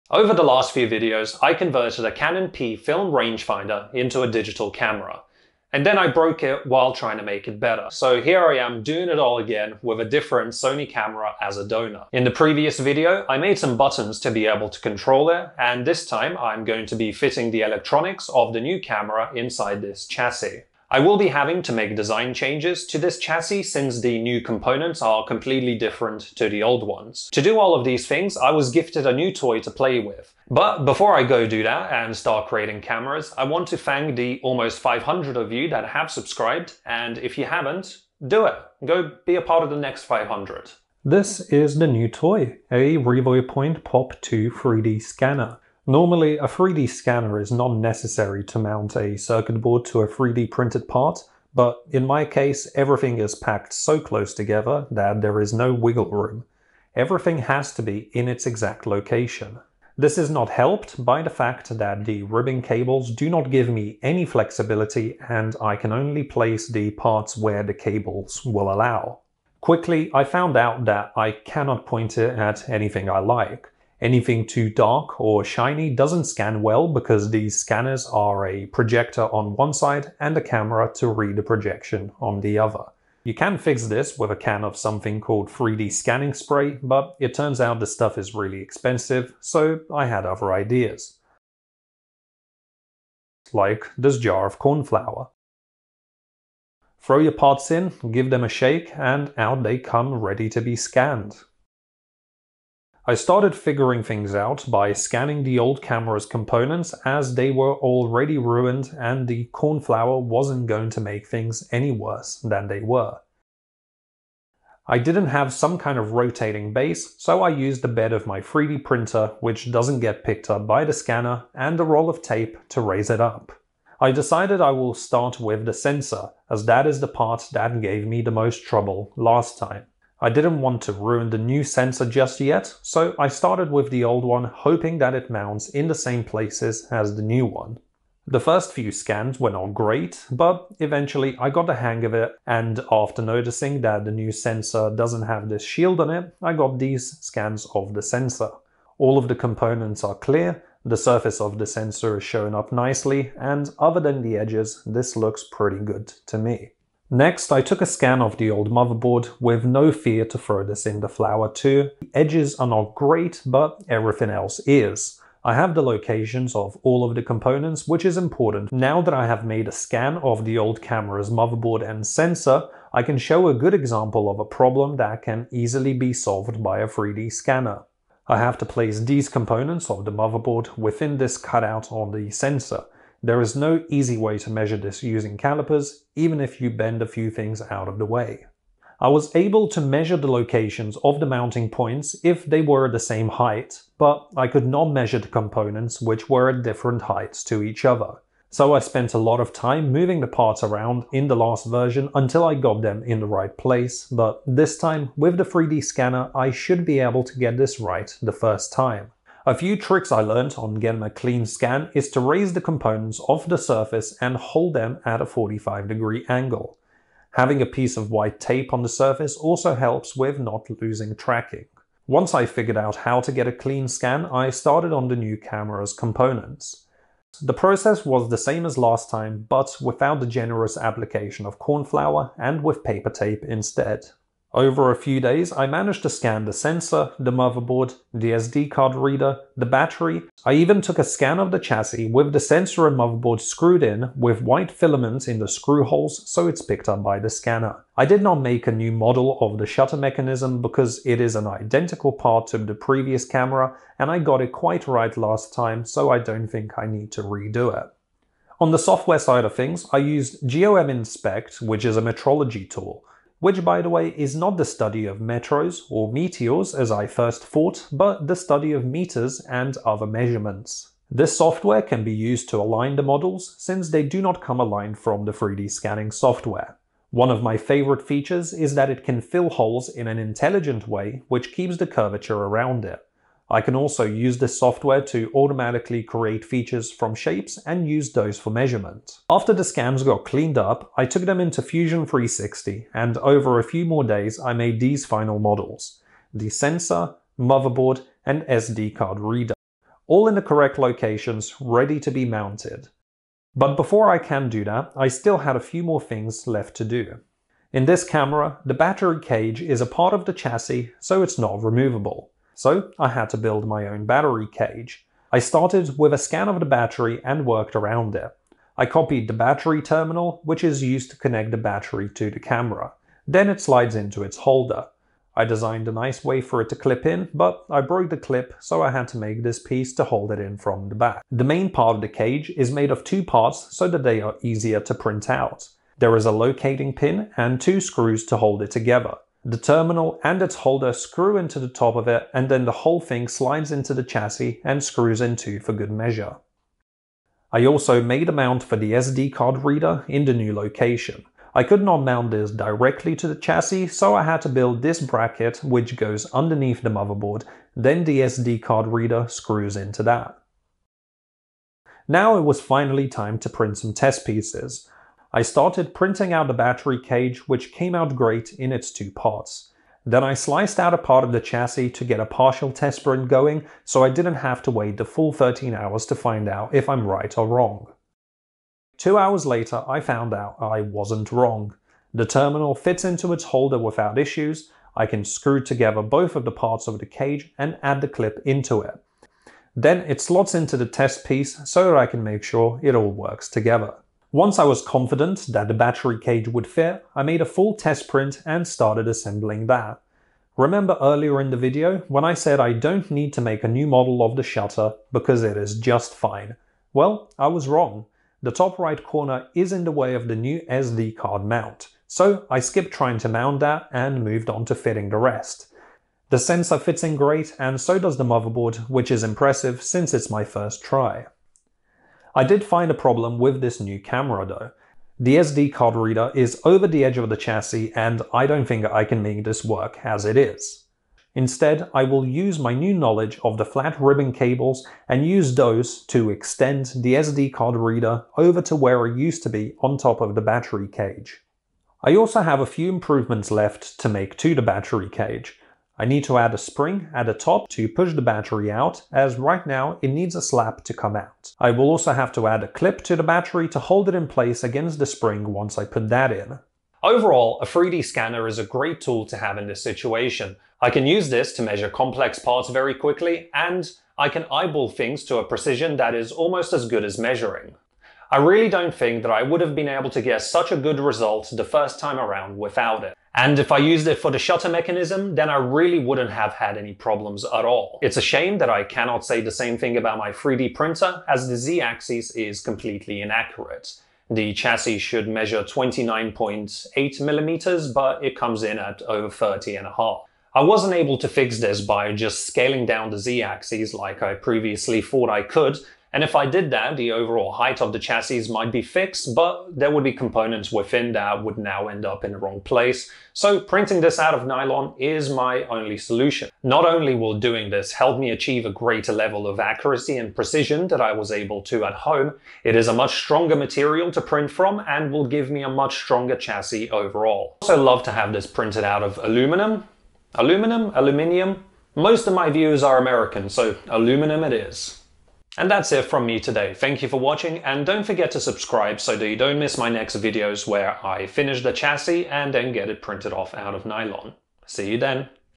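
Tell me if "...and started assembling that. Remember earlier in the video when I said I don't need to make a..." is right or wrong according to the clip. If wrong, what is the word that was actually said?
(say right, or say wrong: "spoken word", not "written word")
right.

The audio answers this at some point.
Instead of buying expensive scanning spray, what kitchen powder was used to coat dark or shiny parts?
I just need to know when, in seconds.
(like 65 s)
94 s.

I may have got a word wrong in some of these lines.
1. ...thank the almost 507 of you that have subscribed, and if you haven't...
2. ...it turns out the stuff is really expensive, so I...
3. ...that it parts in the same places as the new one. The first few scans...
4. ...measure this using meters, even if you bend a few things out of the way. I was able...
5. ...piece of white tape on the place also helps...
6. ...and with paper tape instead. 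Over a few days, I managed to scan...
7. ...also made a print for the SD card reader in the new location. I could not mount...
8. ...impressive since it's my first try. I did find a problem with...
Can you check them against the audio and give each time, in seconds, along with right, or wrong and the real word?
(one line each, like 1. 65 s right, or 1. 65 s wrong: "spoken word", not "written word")
1. 33 s wrong: "500", not "507"
2. 87 s right
3. 134 s wrong: "mounts", not "parts"
4. 184 s wrong: "calipers", not "meters"
5. 217 s wrong: "surface", not "place"
6. 232 s right
7. 347 s wrong: "mount", not "print"
8. 419 s right.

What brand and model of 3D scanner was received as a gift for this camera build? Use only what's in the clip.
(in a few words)
Revopoint Pop 2.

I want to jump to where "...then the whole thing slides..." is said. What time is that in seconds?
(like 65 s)
342 s.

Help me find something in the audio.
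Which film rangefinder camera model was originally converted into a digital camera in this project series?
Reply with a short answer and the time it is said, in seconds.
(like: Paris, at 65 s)
Canon P, at 2 s.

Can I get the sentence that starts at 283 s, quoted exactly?
I can also use this software to automatically create features from shapes and use those for measurement.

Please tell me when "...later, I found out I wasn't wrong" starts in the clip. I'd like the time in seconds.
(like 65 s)
379 s.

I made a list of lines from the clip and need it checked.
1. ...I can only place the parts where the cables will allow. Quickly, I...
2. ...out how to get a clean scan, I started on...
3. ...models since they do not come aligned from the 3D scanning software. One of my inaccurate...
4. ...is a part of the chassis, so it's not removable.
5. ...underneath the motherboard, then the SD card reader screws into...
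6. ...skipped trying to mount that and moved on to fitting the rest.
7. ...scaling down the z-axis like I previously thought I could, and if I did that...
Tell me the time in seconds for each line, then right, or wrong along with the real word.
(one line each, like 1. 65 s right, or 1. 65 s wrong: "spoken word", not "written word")
1. 65 s right
2. 222 s right
3. 273 s wrong: "favorite", not "inaccurate"
4. 309 s right
5. 356 s right
6. 412 s right
7. 492 s right.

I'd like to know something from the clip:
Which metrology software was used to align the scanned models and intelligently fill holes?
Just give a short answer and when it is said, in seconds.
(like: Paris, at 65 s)
GOM Inspect, at 260 s.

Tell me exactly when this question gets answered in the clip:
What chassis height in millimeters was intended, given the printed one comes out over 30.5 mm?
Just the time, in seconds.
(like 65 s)
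485 s.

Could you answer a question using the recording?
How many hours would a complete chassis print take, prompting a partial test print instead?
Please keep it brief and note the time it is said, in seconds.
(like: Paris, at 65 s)
13 hours, at 375 s.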